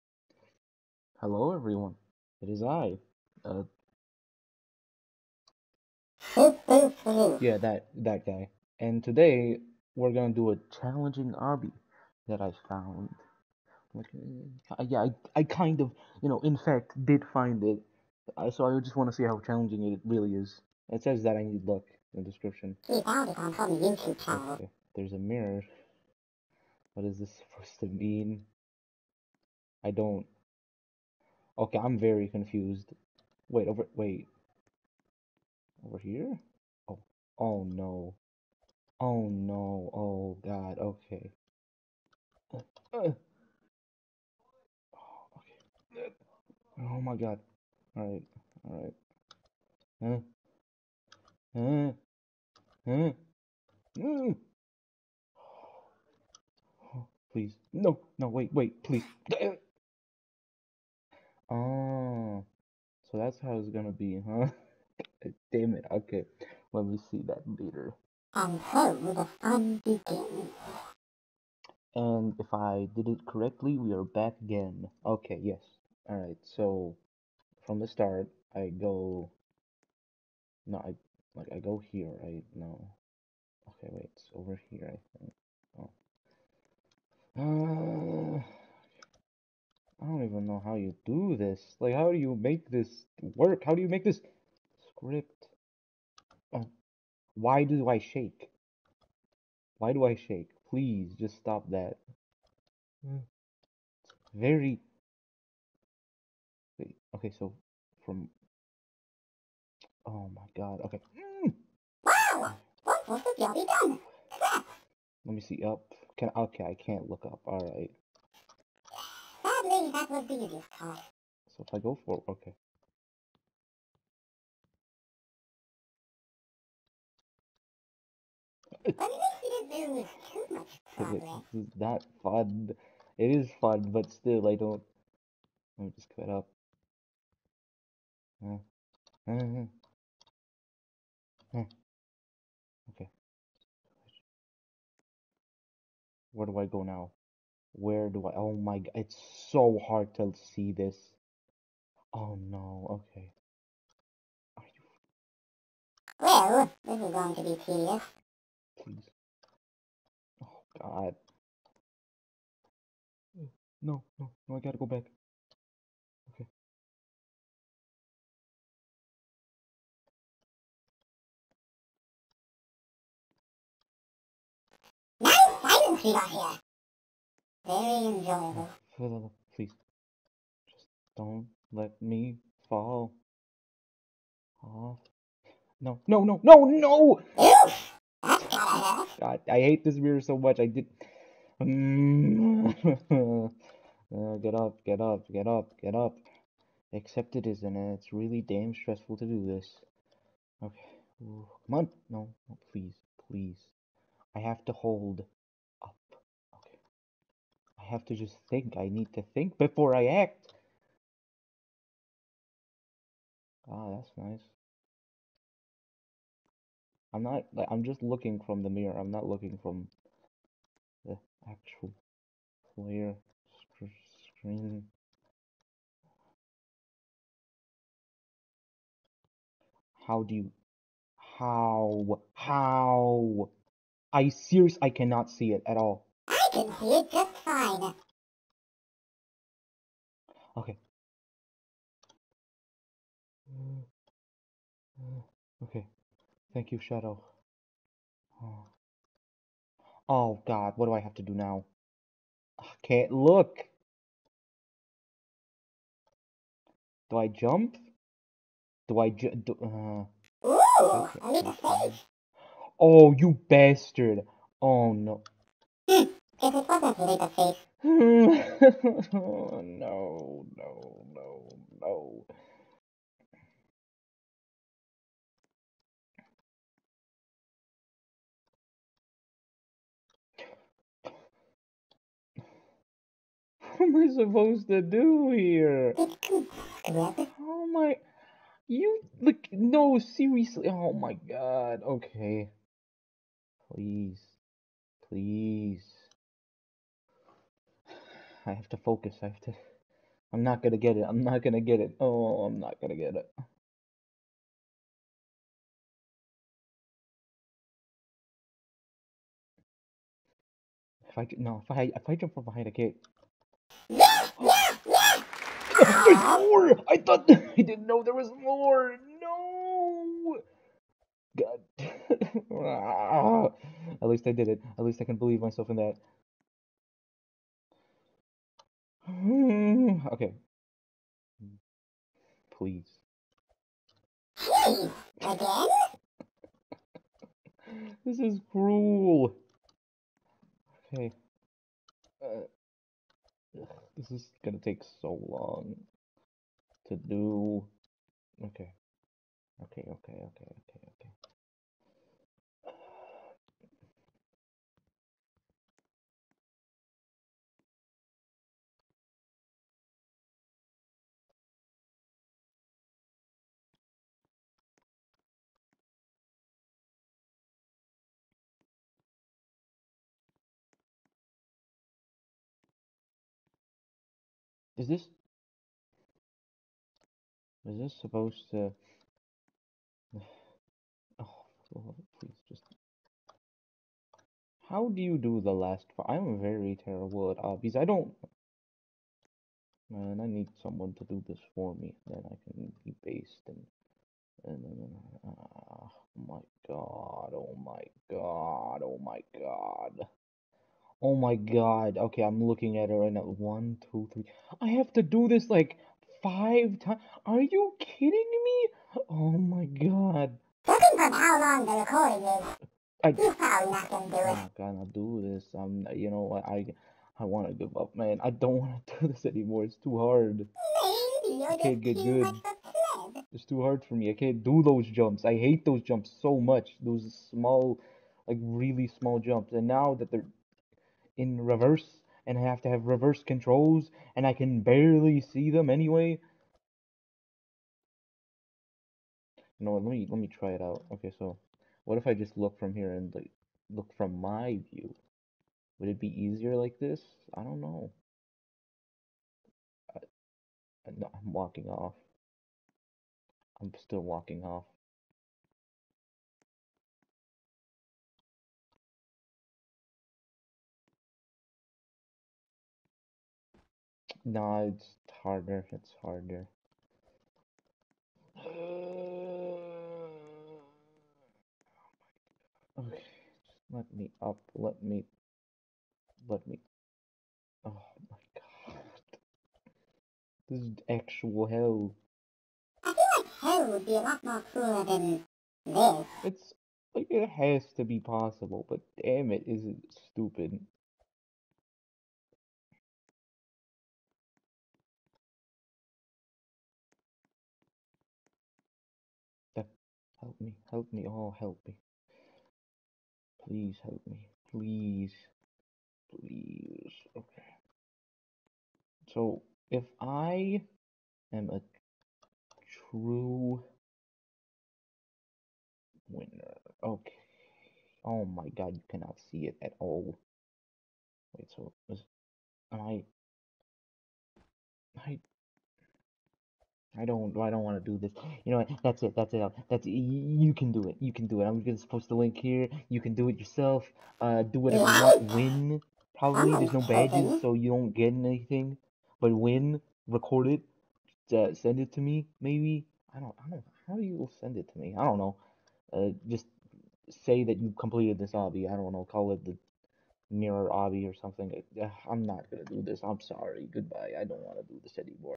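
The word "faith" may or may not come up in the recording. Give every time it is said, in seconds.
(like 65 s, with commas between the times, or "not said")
267 s.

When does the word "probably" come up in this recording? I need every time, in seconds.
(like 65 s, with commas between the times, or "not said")
413 s, 536 s.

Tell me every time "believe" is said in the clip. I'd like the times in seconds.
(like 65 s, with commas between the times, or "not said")
325 s.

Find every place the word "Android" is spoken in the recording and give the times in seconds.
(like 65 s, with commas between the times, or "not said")
not said.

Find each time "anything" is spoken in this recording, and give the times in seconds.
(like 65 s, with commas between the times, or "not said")
538 s.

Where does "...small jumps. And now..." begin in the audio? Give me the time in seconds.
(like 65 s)
428 s.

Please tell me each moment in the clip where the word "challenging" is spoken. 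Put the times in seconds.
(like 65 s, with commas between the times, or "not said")
10 s, 19 s.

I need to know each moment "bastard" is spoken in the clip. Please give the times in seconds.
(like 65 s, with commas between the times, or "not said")
263 s.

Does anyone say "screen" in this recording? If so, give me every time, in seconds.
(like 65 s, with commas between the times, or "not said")
224 s.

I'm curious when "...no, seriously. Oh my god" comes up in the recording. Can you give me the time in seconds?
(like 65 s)
289 s.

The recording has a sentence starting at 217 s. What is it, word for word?
I'm not, like, I'm just looking from the mirror.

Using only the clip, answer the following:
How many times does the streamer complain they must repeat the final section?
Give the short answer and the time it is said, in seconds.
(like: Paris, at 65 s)
5, at 406 s.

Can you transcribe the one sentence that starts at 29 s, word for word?
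I don't Okay, I'm very confused.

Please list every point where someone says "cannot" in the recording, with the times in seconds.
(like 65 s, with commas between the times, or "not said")
234 s, 518 s.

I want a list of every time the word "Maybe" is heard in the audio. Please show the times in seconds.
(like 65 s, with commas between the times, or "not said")
420 s, 542 s.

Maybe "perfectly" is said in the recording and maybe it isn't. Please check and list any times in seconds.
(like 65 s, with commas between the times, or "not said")
not said.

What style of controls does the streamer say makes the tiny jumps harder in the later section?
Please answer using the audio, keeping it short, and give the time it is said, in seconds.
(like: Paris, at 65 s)
Reverse controls, at 432 s.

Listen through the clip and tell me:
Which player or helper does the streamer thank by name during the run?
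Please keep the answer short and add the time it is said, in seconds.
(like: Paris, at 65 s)
Shadow, at 246 s.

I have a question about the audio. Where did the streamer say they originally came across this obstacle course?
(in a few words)
Some YouTube channel.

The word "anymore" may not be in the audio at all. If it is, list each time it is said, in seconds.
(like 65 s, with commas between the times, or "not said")
419 s, 554 s.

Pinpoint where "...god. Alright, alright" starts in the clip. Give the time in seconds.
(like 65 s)
47 s.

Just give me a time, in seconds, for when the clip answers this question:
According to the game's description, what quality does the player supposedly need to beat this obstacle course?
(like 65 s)
21 s.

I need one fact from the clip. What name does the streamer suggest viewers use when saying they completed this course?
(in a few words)
The mirror obby.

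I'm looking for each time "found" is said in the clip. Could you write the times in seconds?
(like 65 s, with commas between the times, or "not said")
12 s, 23 s.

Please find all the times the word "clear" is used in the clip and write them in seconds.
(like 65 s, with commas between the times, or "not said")
222 s.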